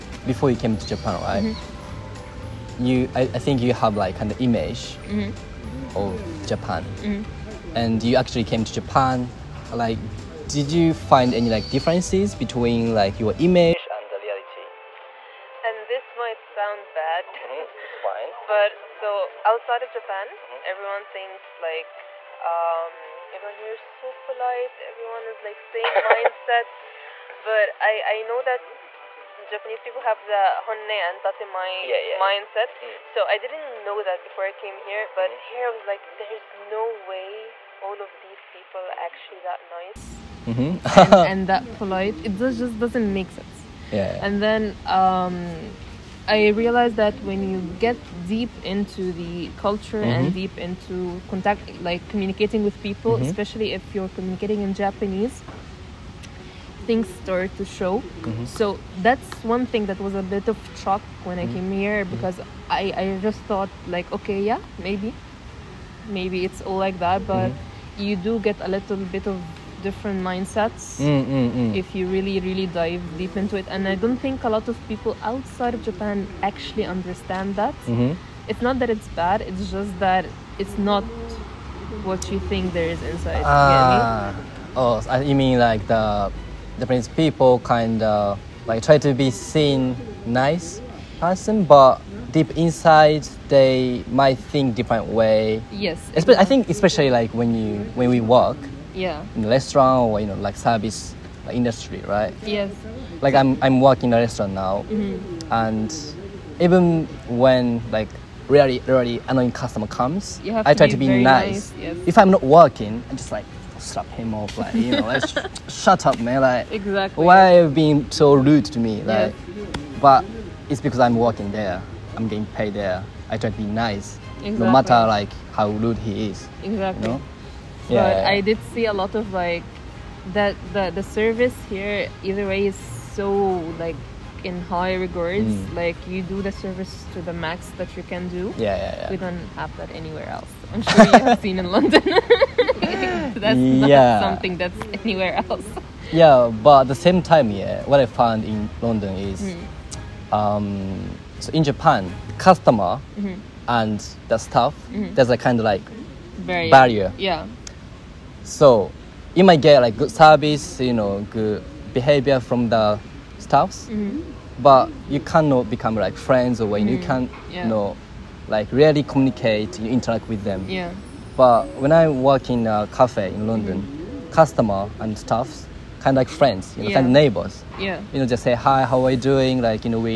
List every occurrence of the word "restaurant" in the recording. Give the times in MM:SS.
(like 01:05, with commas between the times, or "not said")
01:39, 01:44.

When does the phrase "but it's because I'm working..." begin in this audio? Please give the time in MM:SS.
02:00.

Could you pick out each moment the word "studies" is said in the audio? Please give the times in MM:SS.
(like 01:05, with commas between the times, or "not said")
not said.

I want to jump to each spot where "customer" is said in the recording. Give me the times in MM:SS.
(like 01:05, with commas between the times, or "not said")
01:49, 02:32, 02:54.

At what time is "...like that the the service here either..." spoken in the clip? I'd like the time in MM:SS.
02:09.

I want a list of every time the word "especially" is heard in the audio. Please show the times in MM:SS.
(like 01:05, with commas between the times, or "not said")
00:53, 01:36.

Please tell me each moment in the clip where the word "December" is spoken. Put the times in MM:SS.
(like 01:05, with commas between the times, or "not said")
not said.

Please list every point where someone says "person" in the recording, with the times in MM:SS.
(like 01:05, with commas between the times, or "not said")
01:31.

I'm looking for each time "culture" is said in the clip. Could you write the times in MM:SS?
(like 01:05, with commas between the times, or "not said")
00:49.